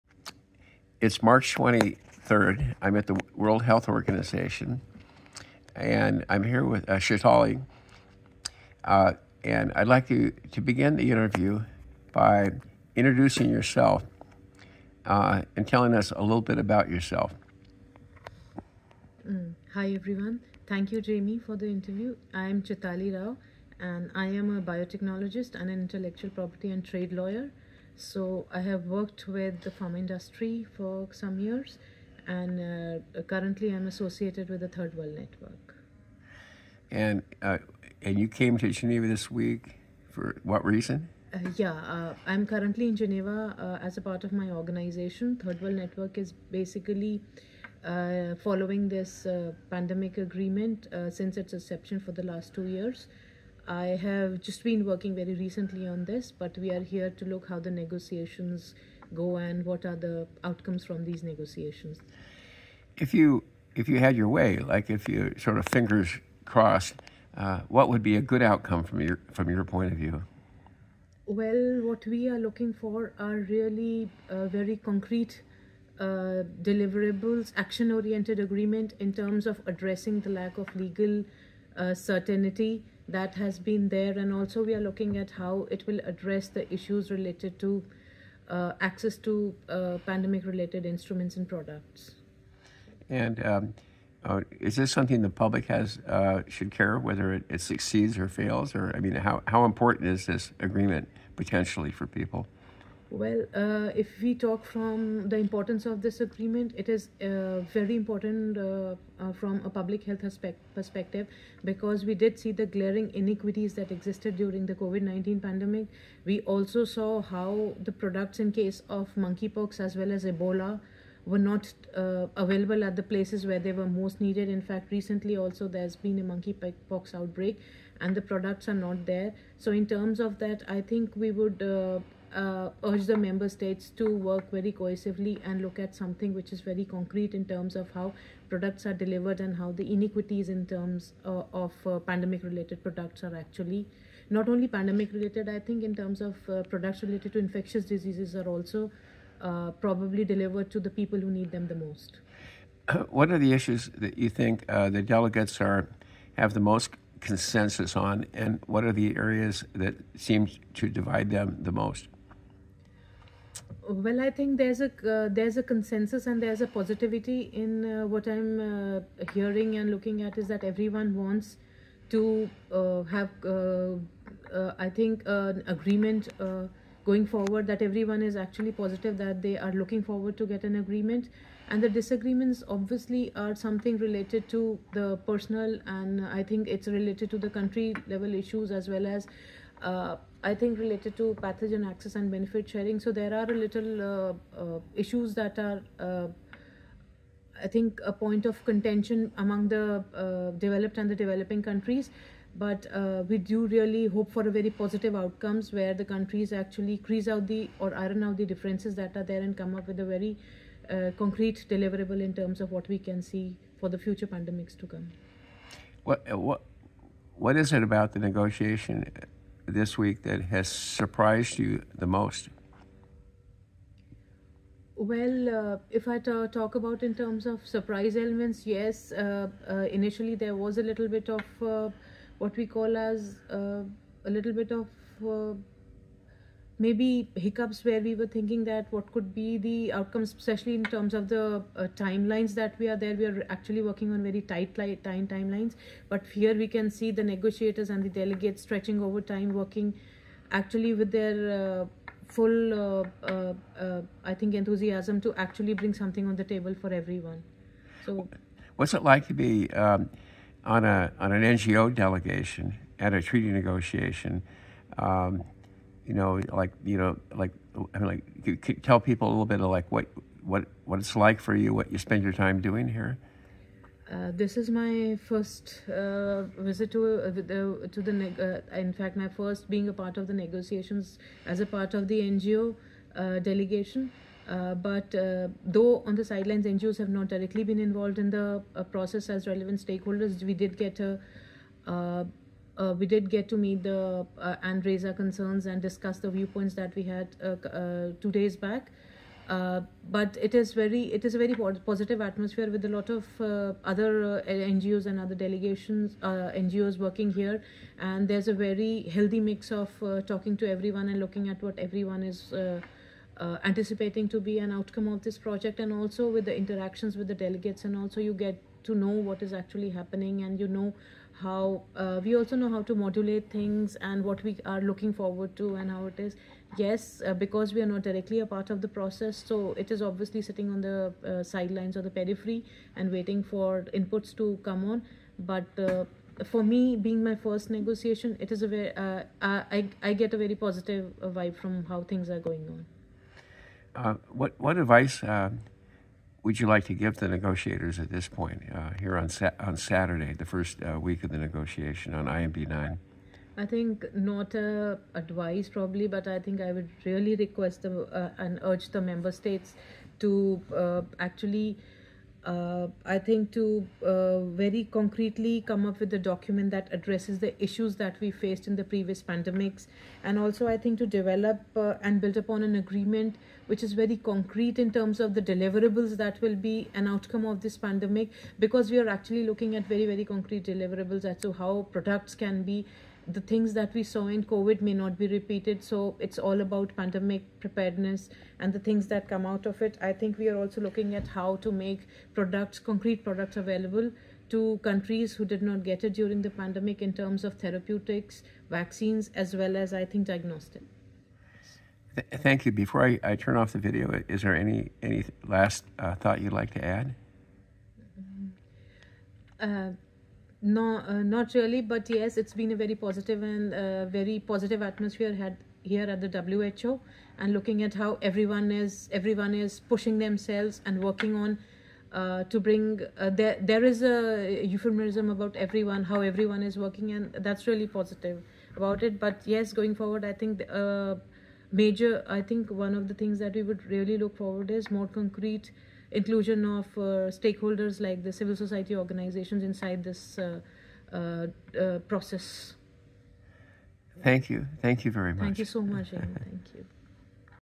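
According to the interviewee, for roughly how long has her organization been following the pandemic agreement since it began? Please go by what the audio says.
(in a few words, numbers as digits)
2 years.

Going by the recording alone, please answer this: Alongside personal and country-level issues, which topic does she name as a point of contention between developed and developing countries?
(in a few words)
pathogen access and benefit sharing.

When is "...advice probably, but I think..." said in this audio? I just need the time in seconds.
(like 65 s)
355 s.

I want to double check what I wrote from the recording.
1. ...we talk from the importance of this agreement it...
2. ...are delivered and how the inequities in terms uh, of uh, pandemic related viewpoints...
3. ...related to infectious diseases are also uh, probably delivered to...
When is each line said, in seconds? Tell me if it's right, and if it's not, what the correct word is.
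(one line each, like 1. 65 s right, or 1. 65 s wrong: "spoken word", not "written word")
1. 104 s right
2. 138 s wrong: "products", not "viewpoints"
3. 147 s right.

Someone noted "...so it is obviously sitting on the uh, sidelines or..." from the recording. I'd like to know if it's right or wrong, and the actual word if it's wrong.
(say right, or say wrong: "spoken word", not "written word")
right.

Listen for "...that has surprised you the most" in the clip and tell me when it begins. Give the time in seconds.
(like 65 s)
220 s.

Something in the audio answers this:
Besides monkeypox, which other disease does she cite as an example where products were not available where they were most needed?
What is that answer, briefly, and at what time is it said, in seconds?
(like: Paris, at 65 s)
Ebola, at 120 s.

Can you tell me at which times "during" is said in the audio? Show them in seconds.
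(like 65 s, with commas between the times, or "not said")
114 s, 396 s.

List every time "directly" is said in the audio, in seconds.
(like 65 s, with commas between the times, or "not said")
287 s, 328 s.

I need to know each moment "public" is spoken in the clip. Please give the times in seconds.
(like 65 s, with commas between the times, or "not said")
95 s, 109 s.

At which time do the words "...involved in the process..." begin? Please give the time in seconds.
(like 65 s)
287 s.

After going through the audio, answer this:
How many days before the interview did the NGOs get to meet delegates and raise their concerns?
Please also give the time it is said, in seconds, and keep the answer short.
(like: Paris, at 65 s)
2 days, at 298 s.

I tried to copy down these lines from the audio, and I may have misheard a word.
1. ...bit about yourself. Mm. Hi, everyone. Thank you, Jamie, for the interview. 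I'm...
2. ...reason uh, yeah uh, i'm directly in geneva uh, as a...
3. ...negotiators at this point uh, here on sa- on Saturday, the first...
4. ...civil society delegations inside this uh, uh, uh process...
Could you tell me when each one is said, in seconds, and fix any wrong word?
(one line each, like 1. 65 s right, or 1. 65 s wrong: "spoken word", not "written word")
1. 16 s right
2. 40 s wrong: "currently", not "directly"
3. 347 s right
4. 438 s wrong: "organizations", not "delegations".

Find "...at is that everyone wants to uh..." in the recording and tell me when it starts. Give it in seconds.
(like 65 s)
170 s.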